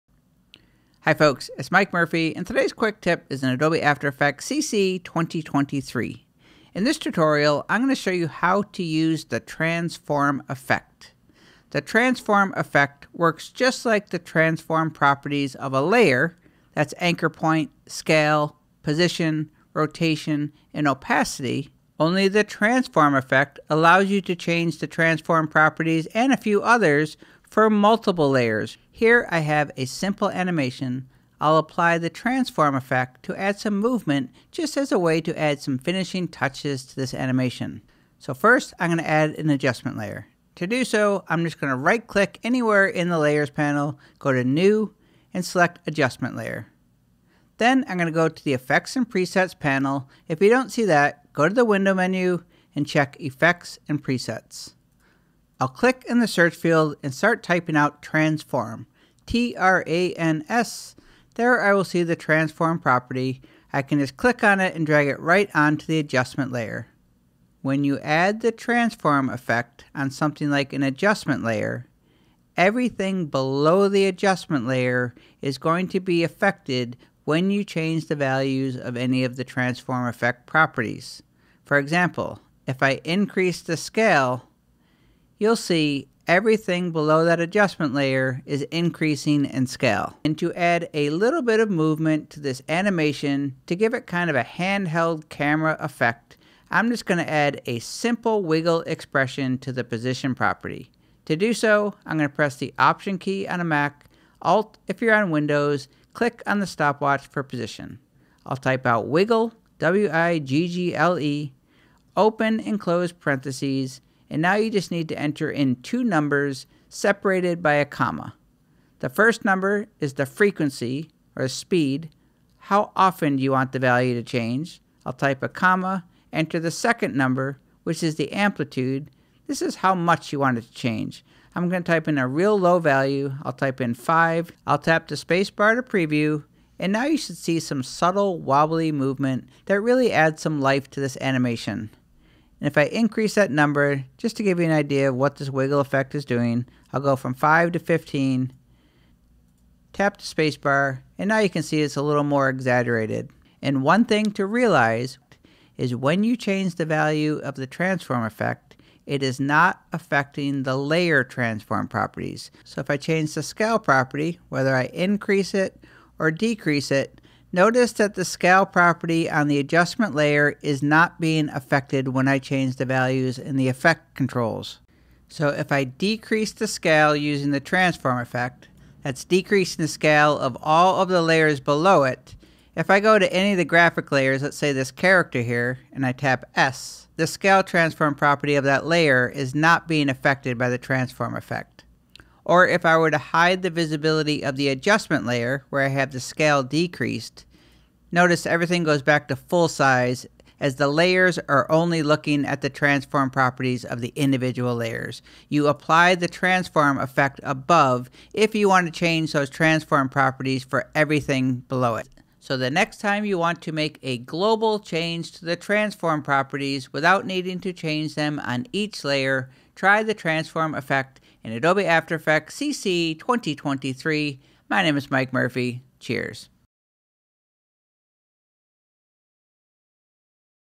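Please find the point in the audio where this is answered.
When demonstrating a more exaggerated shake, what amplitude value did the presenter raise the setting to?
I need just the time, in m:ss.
2:27.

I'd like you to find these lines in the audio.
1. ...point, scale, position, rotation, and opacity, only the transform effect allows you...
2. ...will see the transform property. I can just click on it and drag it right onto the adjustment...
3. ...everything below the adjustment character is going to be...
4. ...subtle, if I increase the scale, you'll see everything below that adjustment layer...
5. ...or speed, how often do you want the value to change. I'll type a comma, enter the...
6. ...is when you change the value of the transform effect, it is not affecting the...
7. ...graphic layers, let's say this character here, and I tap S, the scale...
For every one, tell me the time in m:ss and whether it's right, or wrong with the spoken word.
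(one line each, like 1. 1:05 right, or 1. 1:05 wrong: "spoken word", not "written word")
1. 0:17 right
2. 1:01 right
3. 1:12 wrong: "layer", not "character"
4. 1:21 wrong: "example", not "subtle"
5. 2:01 right
6. 2:35 right
7. 3:03 right.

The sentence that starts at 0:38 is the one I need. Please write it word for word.
So first I'm going to add an adjustment layer.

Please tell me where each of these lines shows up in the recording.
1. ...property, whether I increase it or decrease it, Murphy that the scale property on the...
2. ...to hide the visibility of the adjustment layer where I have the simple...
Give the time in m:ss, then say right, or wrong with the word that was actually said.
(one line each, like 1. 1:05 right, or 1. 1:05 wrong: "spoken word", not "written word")
1. 2:43 wrong: "Notice", not "Murphy"
2. 3:13 wrong: "scale", not "simple".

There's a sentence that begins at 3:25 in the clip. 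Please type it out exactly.
You apply the transform effect above if you want to change those transform properties for everything below it.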